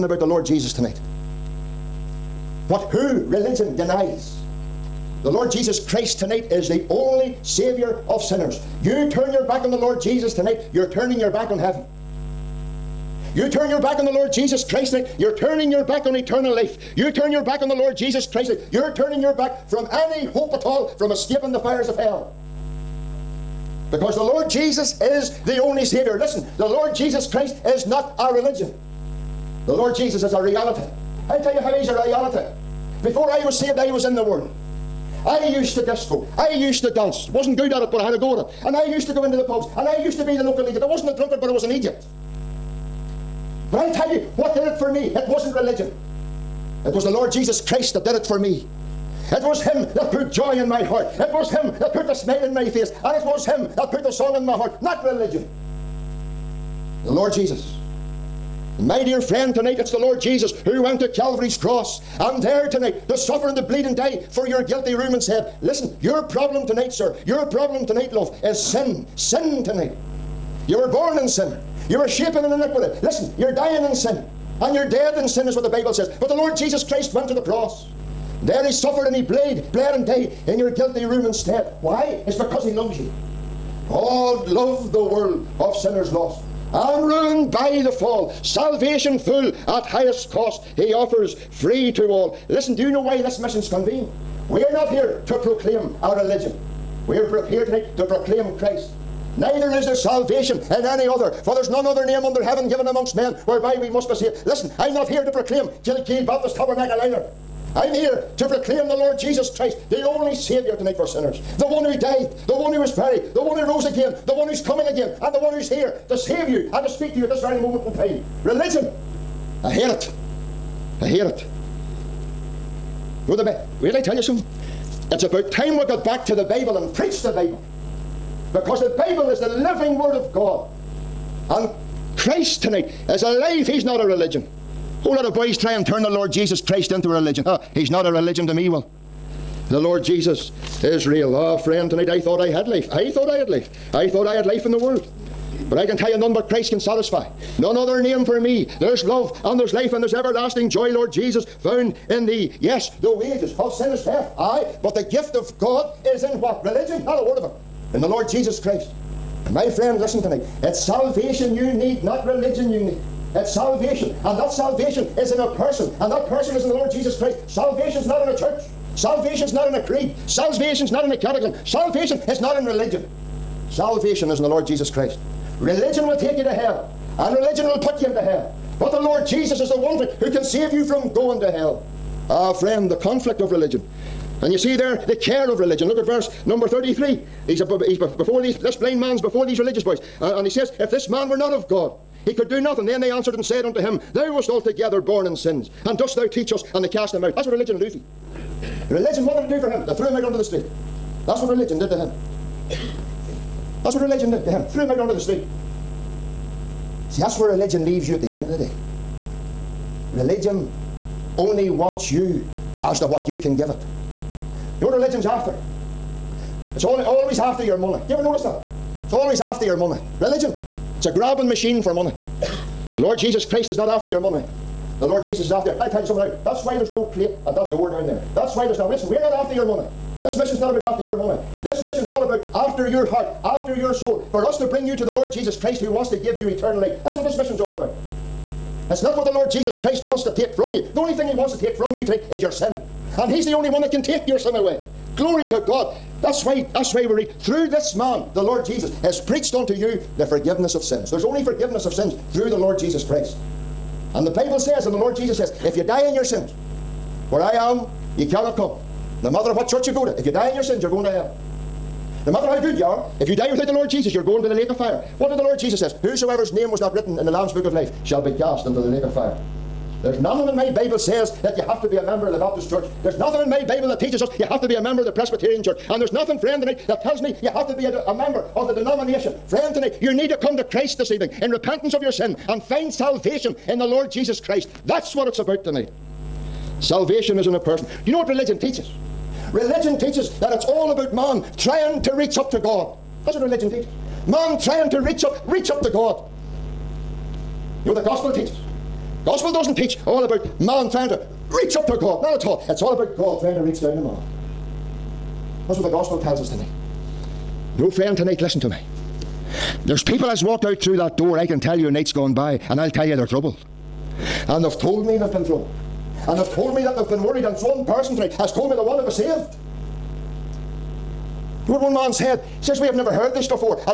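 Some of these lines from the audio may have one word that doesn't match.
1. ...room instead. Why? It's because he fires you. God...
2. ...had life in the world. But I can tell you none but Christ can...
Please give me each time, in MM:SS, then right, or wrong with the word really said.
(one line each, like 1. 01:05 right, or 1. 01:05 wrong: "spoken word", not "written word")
1. 01:21 wrong: "loves", not "fires"
2. 02:24 right.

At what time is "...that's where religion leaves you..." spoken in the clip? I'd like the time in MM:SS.
03:27.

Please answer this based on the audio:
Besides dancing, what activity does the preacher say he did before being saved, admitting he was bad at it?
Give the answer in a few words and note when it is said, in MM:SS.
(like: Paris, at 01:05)
Disco, at 00:35.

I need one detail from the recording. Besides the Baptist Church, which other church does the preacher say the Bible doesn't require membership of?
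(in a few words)
Presbyterian Church.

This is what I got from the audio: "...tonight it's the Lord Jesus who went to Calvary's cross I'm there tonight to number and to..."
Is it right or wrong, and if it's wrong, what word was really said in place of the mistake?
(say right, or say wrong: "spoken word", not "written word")
wrong: "suffer", not "number".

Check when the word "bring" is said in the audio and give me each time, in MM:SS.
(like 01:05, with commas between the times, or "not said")
03:54.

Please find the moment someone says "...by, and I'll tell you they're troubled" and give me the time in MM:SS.
05:12.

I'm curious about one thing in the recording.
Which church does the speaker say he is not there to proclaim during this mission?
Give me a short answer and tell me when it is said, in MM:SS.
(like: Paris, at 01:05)
Kilkeel Baptist Tabernacle, at 01:45.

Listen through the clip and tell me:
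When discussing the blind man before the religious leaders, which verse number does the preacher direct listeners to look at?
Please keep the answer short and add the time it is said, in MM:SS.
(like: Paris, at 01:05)
33, at 03:06.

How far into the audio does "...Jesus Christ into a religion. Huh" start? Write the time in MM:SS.
02:16.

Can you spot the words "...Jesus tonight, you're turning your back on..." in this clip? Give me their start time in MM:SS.
00:10.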